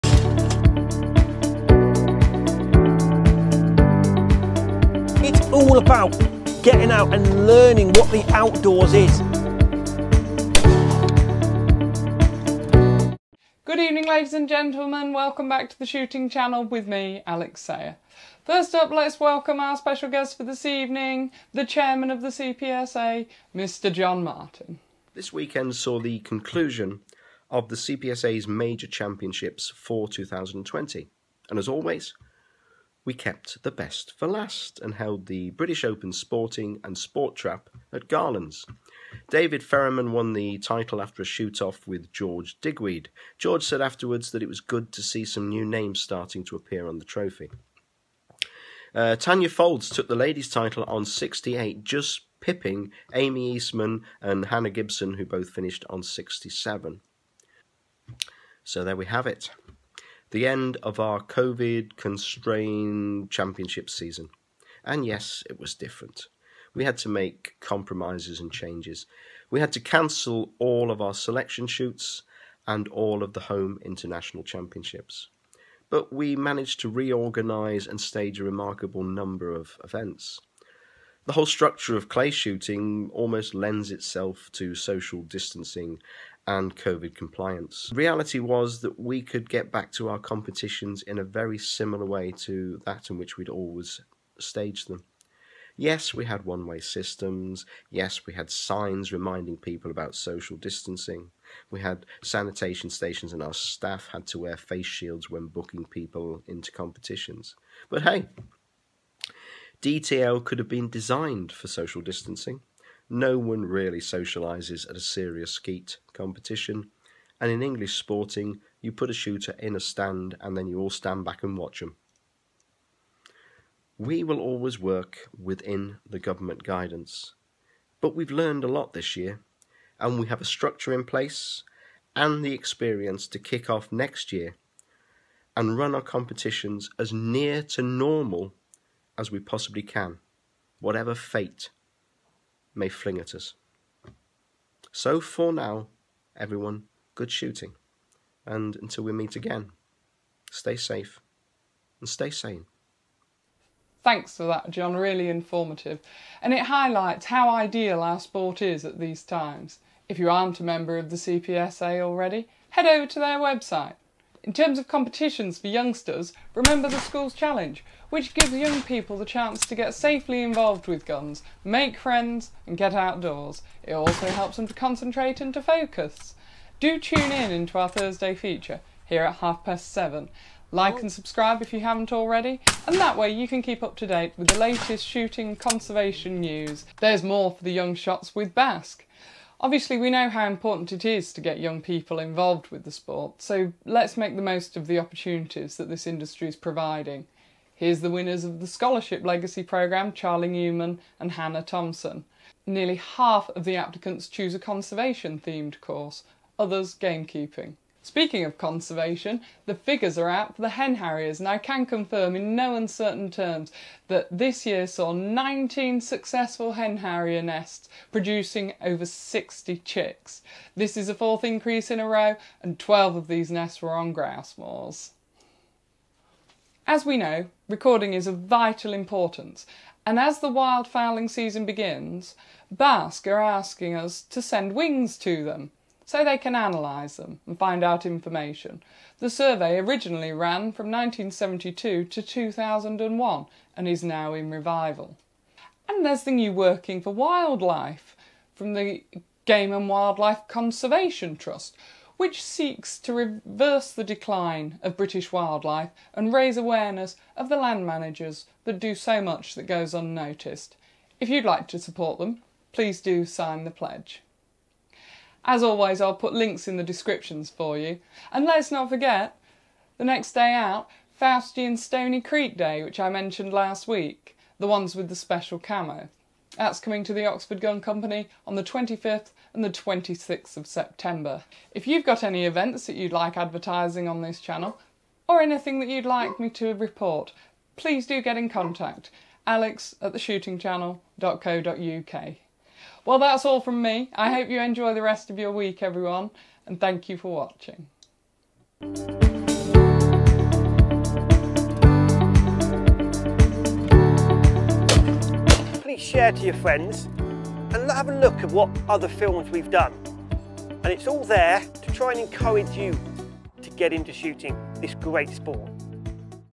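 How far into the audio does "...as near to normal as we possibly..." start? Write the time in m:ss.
2:16.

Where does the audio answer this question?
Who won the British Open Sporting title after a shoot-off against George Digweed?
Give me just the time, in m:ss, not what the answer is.
0:39.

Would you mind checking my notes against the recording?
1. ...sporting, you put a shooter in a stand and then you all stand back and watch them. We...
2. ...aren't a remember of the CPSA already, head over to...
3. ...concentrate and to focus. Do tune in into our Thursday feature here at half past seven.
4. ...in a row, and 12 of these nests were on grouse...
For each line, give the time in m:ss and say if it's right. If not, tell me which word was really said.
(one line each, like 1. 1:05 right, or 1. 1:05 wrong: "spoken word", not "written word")
1. 1:57 right
2. 2:40 wrong: "member", not "remember"
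3. 2:54 right
4. 3:41 right.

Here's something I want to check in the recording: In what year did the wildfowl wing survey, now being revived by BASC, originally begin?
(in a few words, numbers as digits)
1972.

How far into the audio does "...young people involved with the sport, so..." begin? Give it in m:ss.
3:11.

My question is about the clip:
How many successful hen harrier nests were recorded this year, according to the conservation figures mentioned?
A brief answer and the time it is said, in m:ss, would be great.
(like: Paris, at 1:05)
19, at 3:35.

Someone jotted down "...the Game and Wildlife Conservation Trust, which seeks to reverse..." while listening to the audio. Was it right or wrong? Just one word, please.
right.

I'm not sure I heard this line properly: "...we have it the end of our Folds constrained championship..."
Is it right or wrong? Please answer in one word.
wrong.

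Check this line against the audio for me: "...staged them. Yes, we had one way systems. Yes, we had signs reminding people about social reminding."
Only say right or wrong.
wrong.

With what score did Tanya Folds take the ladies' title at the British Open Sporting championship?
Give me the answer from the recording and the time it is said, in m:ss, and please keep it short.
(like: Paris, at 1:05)
68, at 0:51.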